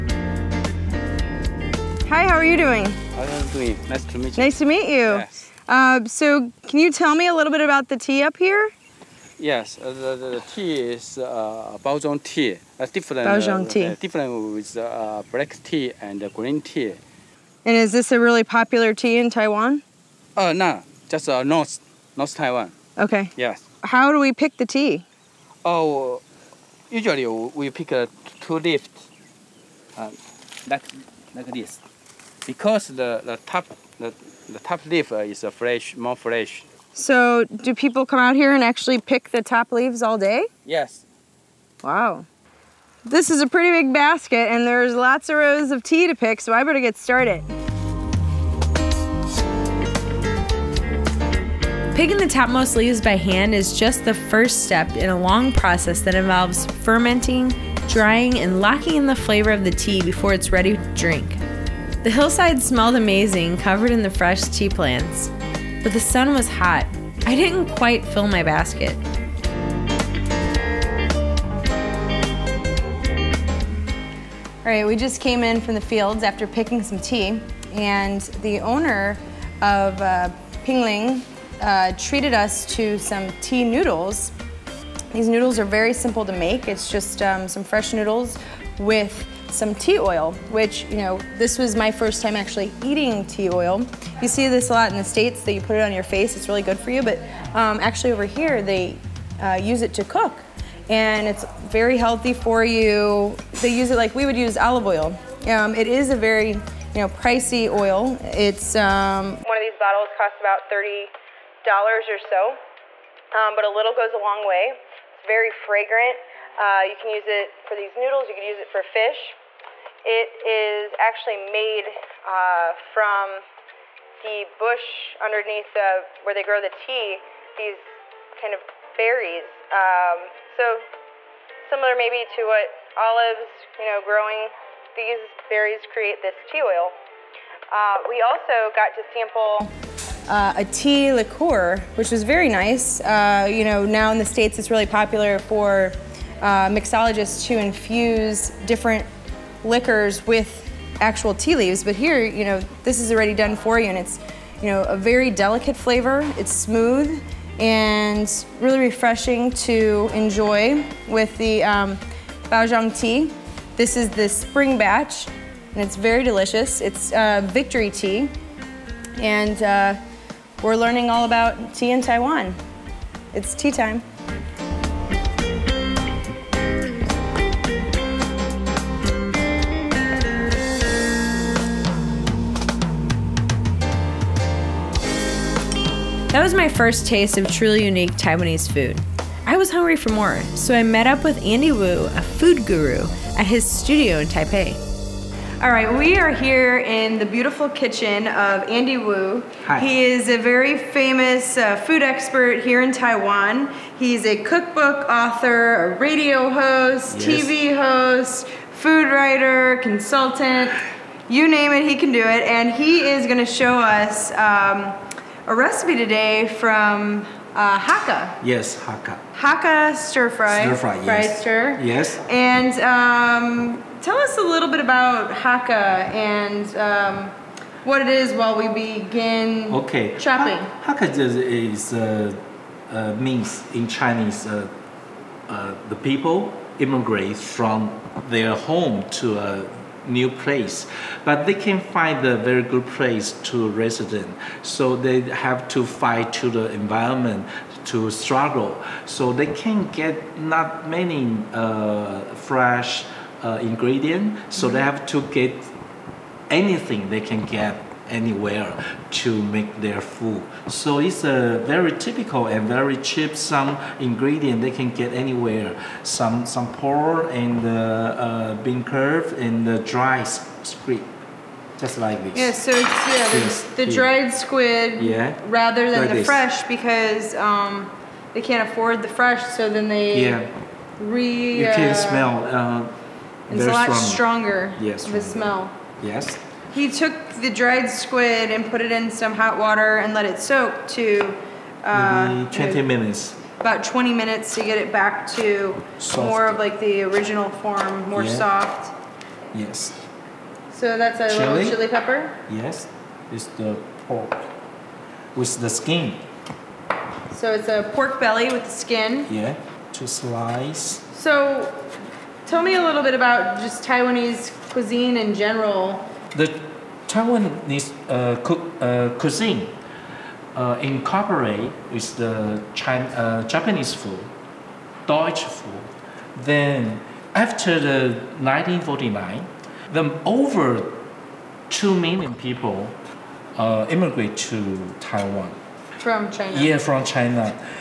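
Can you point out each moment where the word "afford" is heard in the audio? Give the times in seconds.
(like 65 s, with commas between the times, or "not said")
278 s.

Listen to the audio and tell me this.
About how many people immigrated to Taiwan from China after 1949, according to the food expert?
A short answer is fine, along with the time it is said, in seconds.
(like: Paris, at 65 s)
over 2 million, at 330 s.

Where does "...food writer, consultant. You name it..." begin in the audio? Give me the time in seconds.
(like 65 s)
208 s.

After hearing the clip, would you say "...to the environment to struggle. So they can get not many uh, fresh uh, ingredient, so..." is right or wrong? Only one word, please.
right.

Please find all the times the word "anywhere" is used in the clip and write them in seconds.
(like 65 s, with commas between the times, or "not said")
258 s, 265 s.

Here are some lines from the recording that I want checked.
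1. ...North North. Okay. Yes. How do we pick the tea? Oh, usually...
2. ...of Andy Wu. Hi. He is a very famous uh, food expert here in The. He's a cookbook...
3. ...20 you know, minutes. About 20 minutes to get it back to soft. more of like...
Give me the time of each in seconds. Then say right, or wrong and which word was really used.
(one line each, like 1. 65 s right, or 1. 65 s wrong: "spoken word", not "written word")
1. 22 s wrong: "Taiwan", not "North"
2. 198 s wrong: "Taiwan", not "The"
3. 292 s right.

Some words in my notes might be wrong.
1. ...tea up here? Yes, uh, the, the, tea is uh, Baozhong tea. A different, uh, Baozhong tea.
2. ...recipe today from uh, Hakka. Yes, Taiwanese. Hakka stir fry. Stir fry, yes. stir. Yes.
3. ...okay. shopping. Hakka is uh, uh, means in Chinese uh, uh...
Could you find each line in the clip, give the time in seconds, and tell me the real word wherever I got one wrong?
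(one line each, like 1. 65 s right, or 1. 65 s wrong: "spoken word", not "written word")
1. 7 s right
2. 215 s wrong: "Hakka", not "Taiwanese"
3. 229 s right.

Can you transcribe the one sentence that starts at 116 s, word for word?
Uh, you can use it for these noodles, you can use it for fish.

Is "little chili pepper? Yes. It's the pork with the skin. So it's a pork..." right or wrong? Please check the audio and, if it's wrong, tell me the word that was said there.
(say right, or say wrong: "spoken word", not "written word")
right.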